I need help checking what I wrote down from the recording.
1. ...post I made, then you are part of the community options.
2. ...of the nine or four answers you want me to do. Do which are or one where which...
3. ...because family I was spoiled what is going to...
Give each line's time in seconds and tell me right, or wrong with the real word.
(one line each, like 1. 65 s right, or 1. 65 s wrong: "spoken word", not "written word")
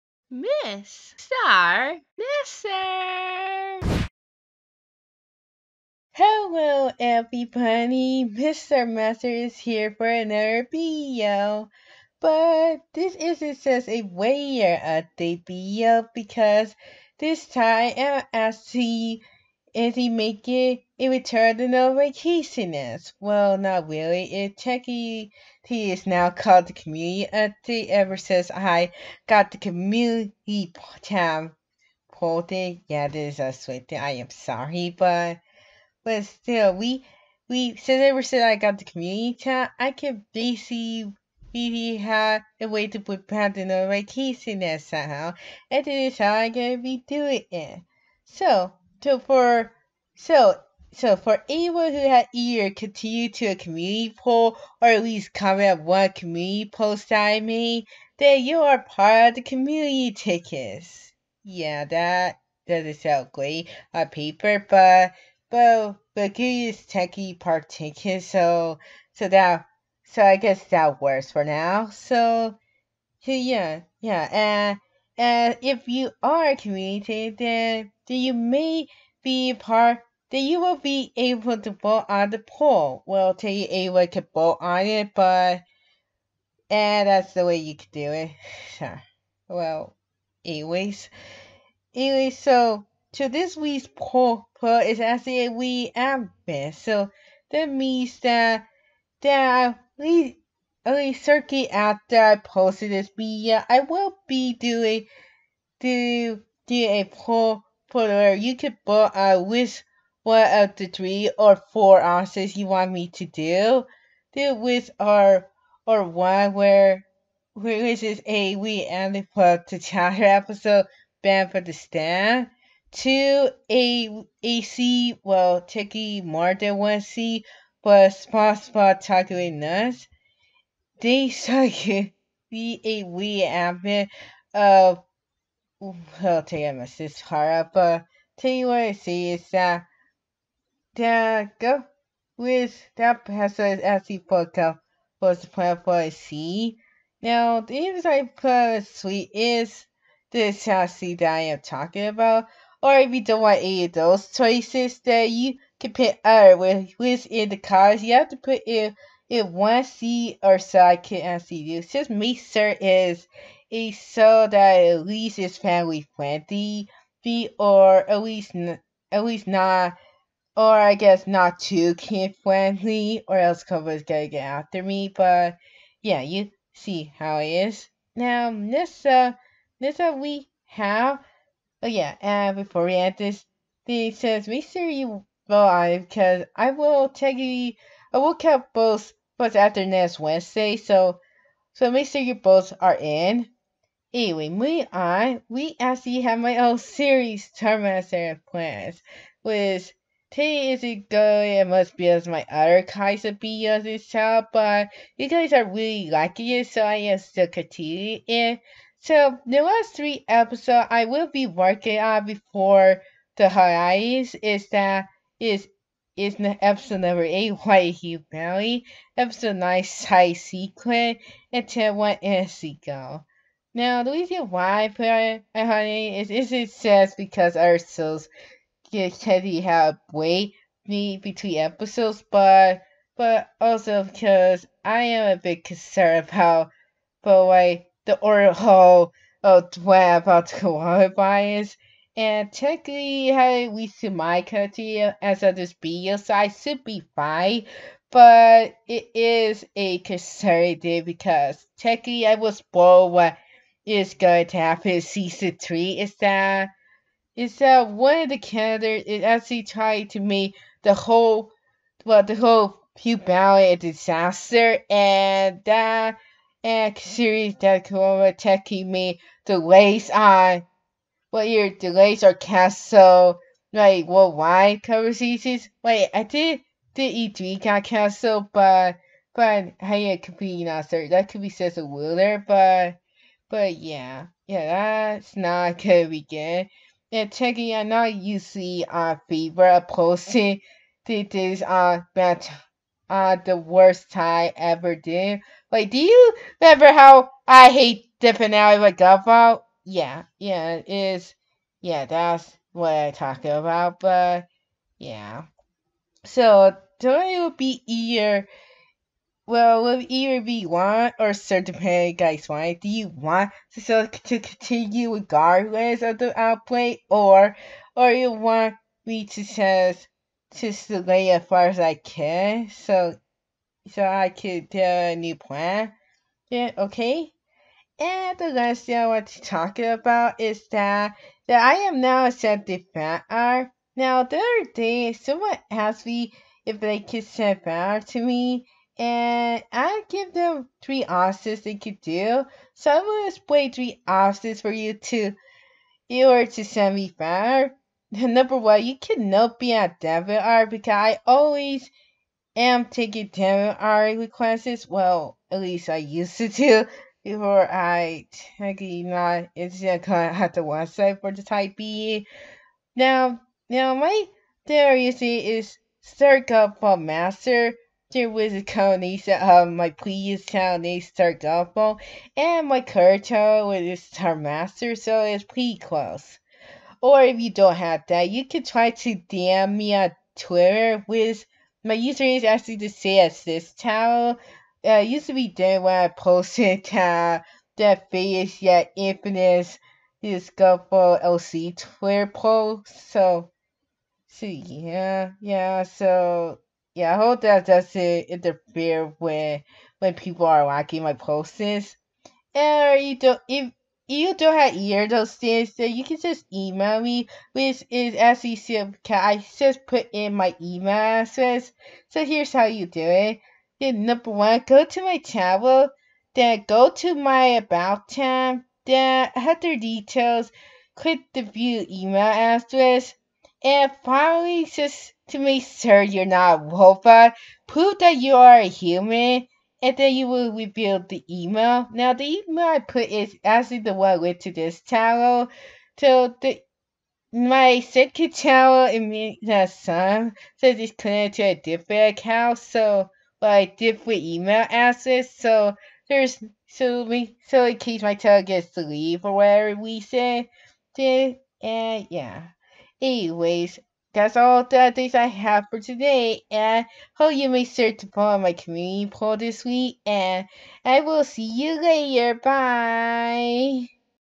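1. 56 s wrong: "chickens", not "options"
2. 110 s wrong: "three", not "nine"
3. 251 s wrong: "technically", not "family".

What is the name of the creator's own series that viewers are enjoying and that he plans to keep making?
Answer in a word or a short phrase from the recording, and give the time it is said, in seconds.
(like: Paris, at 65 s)
Terminator Plans, at 197 s.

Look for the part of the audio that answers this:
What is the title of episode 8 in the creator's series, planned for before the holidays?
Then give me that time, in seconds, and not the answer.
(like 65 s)
217 s.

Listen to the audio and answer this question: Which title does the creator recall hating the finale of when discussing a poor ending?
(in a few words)
Godfall.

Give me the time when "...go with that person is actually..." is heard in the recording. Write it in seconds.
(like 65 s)
141 s.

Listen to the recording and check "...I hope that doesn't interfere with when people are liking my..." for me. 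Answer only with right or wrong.
right.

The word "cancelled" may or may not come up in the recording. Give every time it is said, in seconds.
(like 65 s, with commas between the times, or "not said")
272 s, 277 s.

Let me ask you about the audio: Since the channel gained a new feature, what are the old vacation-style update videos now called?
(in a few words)
the community update.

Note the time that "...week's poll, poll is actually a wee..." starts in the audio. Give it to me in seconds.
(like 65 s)
93 s.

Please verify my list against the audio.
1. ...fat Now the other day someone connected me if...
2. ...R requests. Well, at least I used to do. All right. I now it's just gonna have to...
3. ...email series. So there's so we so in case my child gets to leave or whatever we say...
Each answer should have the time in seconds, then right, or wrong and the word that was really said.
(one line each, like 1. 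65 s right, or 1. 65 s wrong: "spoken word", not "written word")
1. 332 s wrong: "asked", not "connected"
2. 353 s right
3. 444 s wrong: "addresses", not "series".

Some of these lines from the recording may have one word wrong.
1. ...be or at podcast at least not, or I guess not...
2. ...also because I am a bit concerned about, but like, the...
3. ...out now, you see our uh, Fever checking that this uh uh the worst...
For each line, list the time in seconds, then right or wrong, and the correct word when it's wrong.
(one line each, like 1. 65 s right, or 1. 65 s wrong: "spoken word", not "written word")
1. 167 s wrong: "least", not "podcast"
2. 233 s right
3. 287 s wrong: "posting", not "checking".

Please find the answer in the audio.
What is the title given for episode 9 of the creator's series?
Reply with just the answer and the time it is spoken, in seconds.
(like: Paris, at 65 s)
Side Secret, at 219 s.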